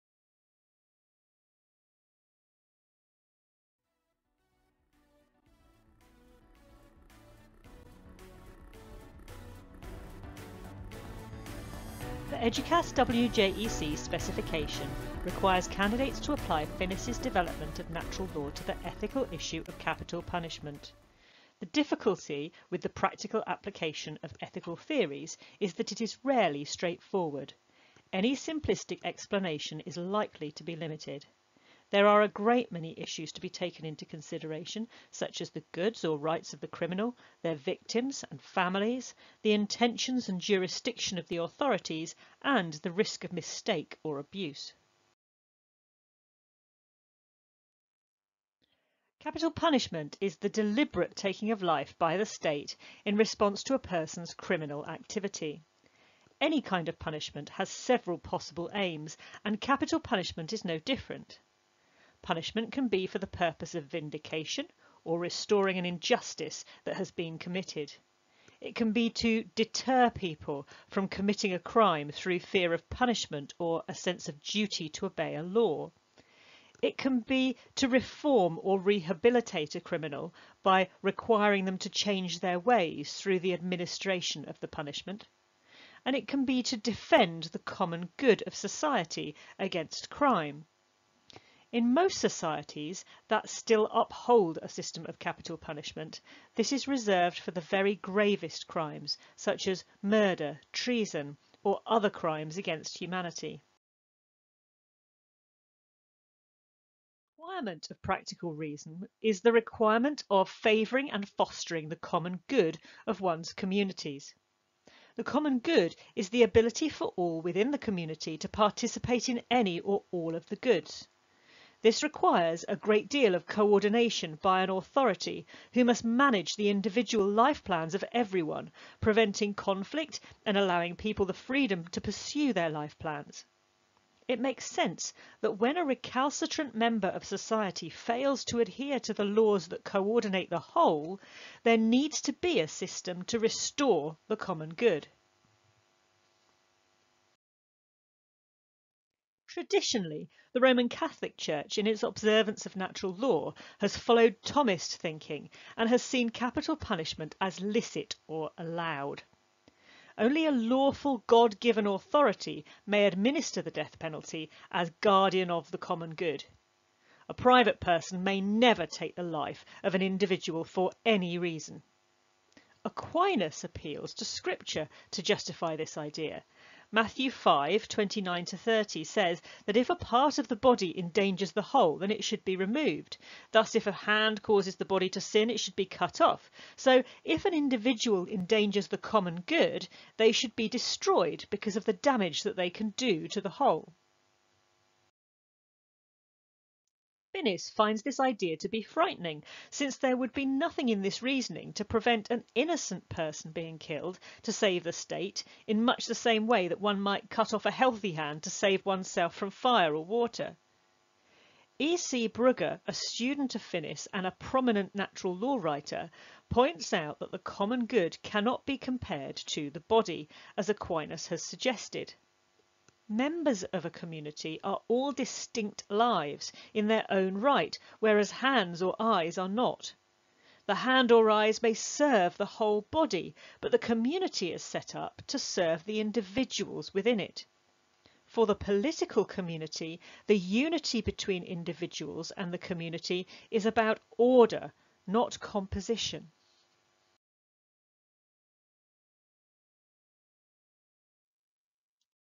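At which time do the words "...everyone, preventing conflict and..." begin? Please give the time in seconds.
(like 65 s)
128 s.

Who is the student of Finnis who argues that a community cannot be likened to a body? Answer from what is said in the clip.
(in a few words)
E.C. Brugger.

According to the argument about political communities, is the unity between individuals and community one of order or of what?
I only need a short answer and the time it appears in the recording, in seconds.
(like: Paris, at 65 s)
composition, at 245 s.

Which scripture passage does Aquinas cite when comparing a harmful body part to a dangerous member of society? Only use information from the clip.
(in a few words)
Matthew 5.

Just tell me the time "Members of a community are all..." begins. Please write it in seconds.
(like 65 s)
223 s.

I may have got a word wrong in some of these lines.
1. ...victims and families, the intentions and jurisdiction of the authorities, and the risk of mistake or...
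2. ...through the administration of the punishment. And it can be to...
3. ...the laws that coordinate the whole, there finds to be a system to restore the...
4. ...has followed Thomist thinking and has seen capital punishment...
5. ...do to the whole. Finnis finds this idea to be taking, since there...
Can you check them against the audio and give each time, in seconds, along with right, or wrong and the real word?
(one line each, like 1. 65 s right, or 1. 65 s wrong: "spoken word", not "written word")
1. 37 s right
2. 83 s right
3. 139 s wrong: "needs", not "finds"
4. 153 s right
5. 192 s wrong: "frightening", not "taking".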